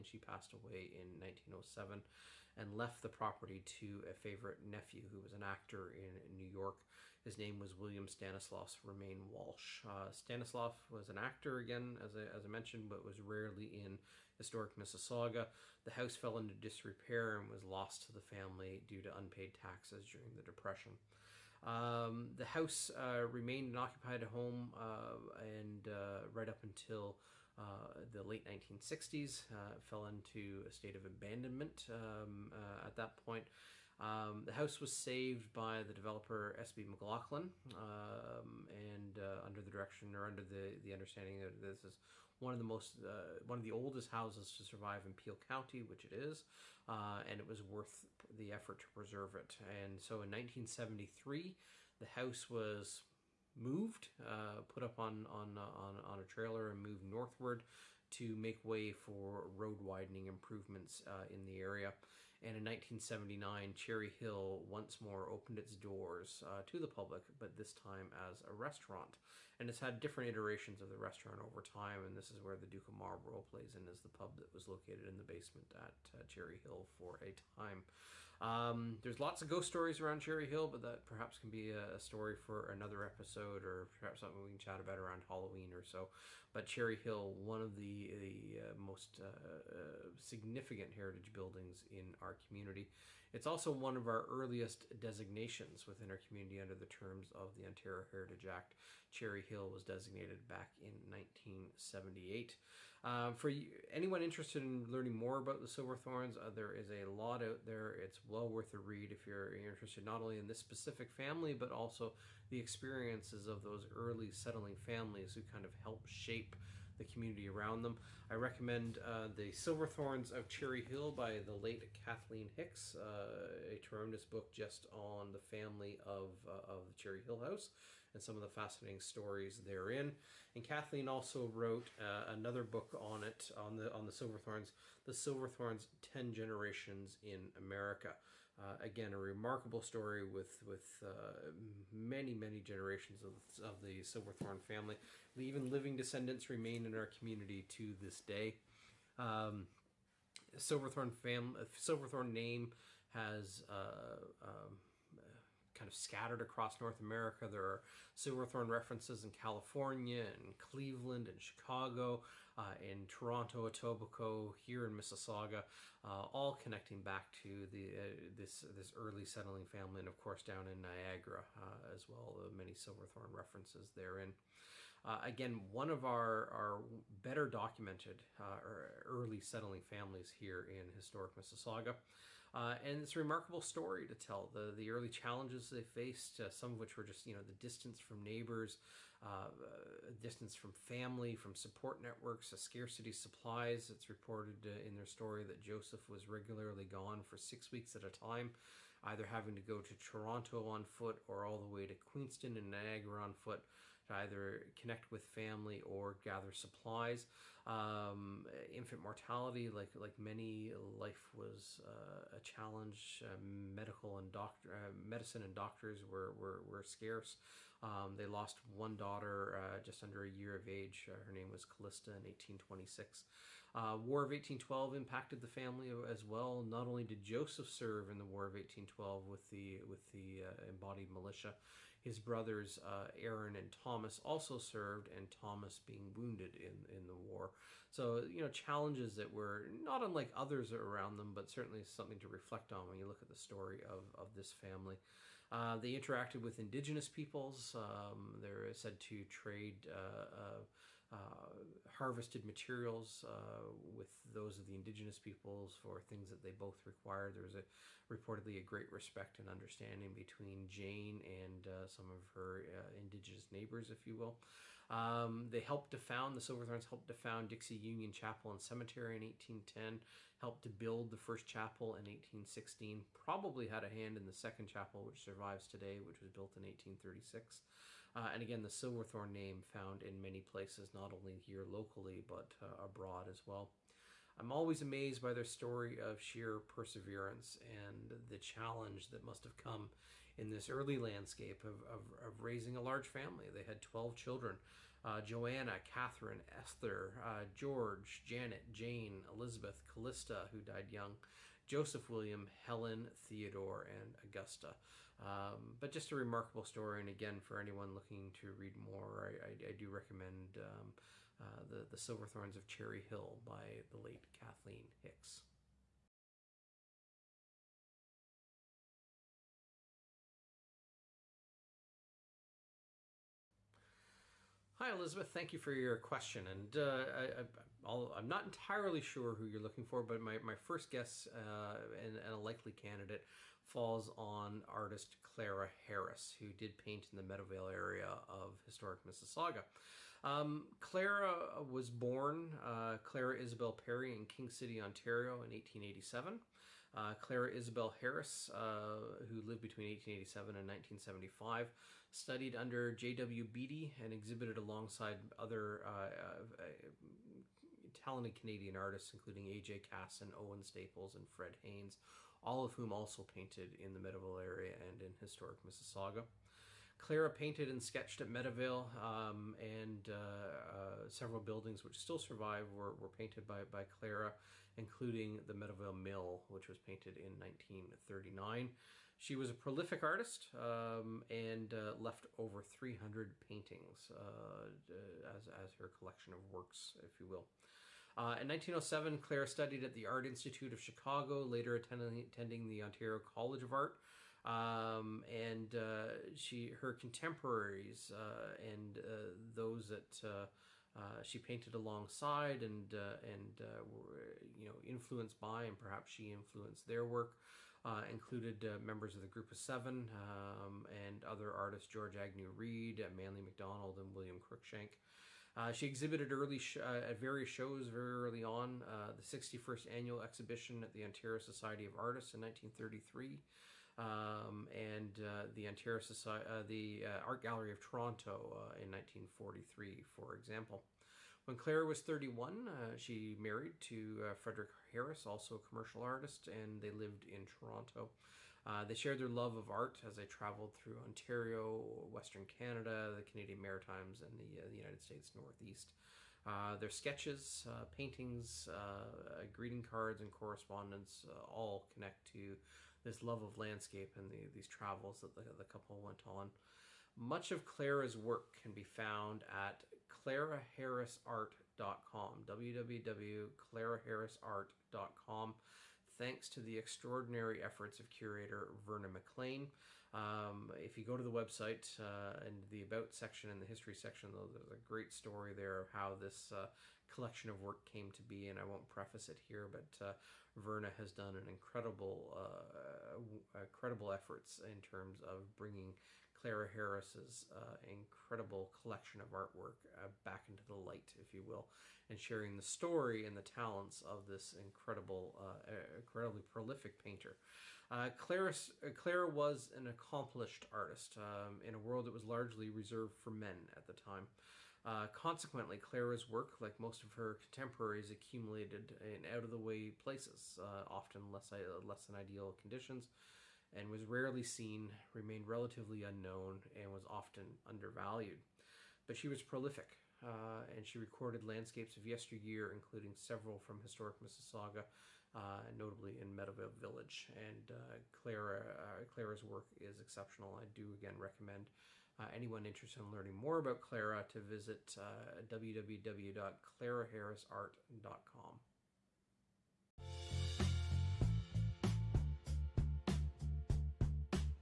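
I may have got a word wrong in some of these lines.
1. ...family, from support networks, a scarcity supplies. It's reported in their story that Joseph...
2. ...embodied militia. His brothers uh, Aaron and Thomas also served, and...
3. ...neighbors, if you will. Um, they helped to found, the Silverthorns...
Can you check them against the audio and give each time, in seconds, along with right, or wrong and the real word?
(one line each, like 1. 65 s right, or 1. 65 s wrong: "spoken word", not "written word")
1. 190 s right
2. 230 s right
3. 263 s right.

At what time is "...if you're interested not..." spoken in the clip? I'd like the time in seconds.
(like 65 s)
109 s.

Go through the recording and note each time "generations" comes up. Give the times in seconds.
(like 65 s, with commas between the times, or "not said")
136 s, 142 s.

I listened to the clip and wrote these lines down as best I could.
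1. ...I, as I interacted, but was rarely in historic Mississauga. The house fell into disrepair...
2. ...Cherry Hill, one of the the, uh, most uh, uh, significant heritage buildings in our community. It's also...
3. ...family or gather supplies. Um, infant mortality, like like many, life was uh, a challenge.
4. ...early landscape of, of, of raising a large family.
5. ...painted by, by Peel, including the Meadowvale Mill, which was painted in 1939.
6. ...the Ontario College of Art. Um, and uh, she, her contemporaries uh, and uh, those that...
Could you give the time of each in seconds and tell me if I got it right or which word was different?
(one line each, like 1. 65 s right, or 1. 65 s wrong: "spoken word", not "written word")
1. 12 s wrong: "mentioned", not "interacted"
2. 86 s right
3. 205 s right
4. 290 s right
5. 373 s wrong: "Clara", not "Peel"
6. 392 s right.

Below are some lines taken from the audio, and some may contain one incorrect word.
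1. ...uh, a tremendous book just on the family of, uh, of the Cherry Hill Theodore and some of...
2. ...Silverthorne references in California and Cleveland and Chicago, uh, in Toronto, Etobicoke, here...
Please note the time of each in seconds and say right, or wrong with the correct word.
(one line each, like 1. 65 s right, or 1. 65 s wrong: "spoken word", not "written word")
1. 122 s wrong: "House", not "Theodore"
2. 158 s right.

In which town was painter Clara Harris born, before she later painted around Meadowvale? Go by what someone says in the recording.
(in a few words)
King City.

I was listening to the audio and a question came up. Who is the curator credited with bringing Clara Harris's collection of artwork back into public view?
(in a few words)
Verna McLean.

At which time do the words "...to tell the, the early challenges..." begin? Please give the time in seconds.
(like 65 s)
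184 s.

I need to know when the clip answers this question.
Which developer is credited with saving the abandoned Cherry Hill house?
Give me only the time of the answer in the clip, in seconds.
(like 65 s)
36 s.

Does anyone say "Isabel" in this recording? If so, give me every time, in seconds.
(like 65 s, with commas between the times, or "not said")
343 s, 347 s.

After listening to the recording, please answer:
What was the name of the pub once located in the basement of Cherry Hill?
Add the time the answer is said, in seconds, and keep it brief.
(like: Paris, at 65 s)
Duke of Marlborough, at 72 s.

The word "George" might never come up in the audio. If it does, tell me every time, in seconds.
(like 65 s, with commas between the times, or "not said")
297 s, 411 s.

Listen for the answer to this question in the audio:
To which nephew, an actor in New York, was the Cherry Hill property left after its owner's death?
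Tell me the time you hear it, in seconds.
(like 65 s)
7 s.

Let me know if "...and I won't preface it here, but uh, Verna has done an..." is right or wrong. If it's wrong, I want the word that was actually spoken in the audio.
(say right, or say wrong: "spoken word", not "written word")
right.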